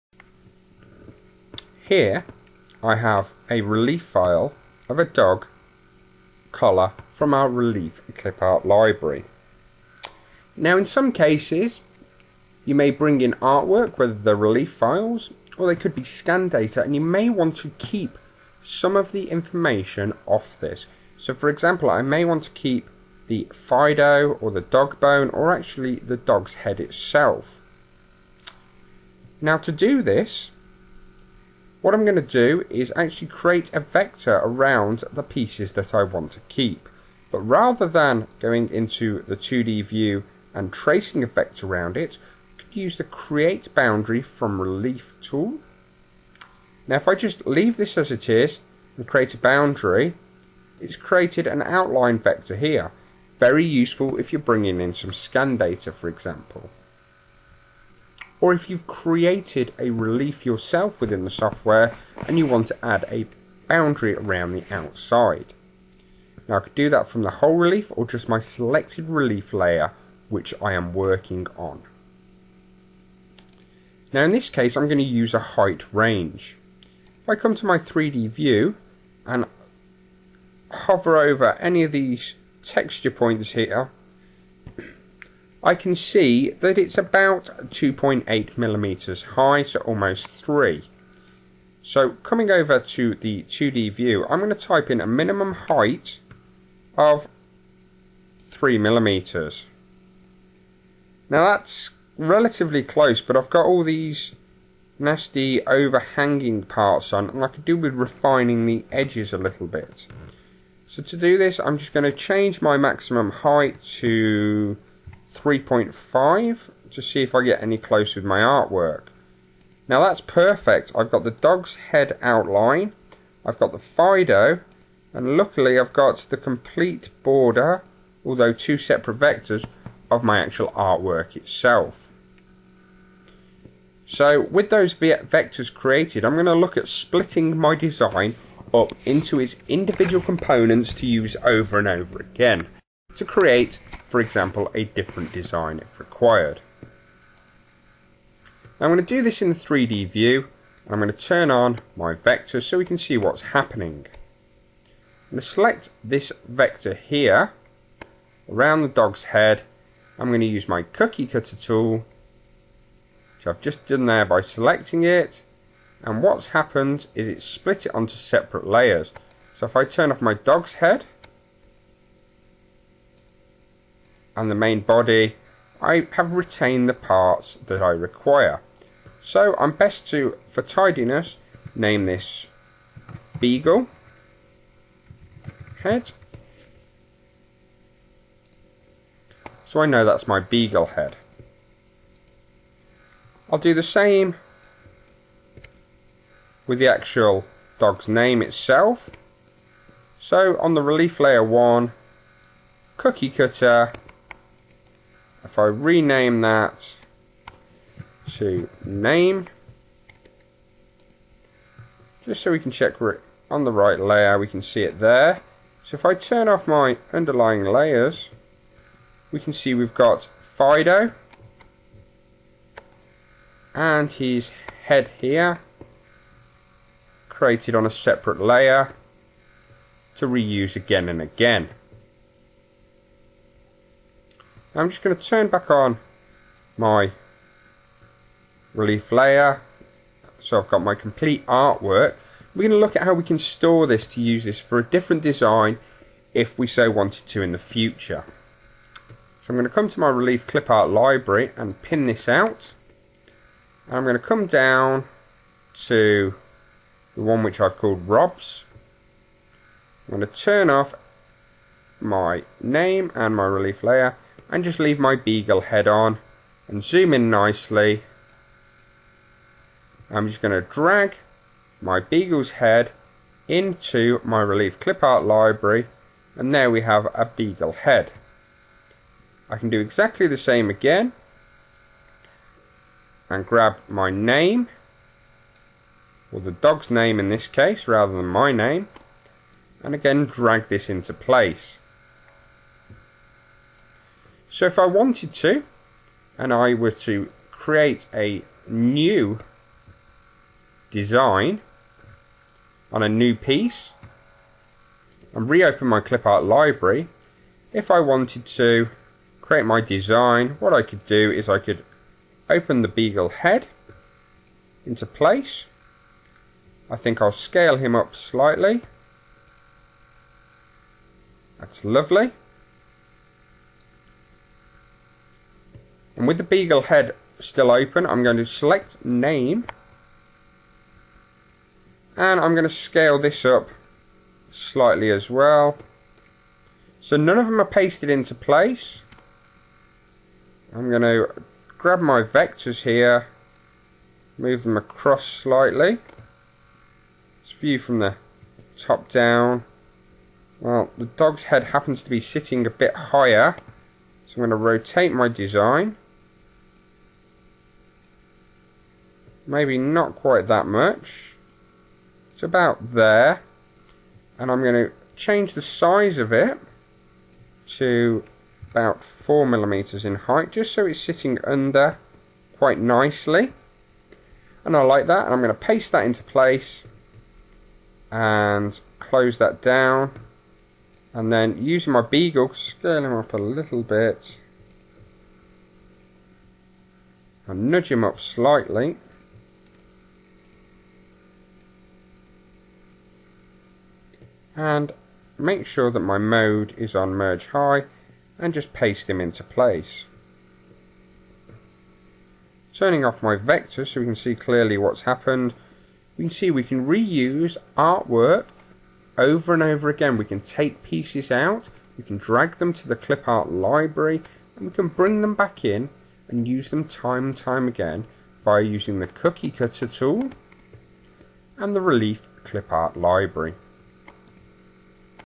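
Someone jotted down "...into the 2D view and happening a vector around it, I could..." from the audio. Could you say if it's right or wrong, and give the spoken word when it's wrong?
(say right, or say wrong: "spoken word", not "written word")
wrong: "tracing", not "happening".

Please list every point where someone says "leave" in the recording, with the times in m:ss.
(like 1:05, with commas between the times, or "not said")
0:47, 4:24.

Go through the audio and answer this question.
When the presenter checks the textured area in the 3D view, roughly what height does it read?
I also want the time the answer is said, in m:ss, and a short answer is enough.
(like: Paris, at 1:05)
2.8 millimeters, at 1:27.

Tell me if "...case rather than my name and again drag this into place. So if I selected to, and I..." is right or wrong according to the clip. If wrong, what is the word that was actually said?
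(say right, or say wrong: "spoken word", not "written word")
wrong: "wanted", not "selected".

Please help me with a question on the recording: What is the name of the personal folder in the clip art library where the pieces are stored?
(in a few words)
Rob's.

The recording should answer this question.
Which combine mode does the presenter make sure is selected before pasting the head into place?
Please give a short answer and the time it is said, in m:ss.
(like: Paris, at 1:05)
merge high, at 6:37.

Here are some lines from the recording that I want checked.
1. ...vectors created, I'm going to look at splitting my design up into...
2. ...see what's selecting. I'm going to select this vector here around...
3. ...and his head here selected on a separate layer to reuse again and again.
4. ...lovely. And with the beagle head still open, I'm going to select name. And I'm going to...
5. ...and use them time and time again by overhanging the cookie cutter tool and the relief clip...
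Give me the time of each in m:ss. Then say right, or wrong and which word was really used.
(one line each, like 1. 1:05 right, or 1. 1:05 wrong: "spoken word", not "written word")
1. 2:14 right
2. 2:32 wrong: "happening", not "selecting"
3. 3:43 wrong: "created", not "selected"
4. 5:21 right
5. 6:56 wrong: "using", not "overhanging".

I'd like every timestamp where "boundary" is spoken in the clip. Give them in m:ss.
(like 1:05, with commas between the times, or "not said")
0:43, 0:49, 1:03.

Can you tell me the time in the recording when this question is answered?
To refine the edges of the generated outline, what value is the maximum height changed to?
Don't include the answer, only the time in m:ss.
1:55.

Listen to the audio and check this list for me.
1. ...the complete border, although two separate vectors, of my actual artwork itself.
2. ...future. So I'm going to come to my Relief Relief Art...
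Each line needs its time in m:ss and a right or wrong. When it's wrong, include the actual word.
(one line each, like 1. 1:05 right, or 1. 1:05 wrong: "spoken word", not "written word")
1. 2:06 right
2. 4:07 wrong: "Clip", not "Relief".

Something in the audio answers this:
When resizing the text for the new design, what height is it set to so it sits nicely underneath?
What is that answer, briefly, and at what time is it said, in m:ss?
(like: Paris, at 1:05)
4 millimeters, at 6:09.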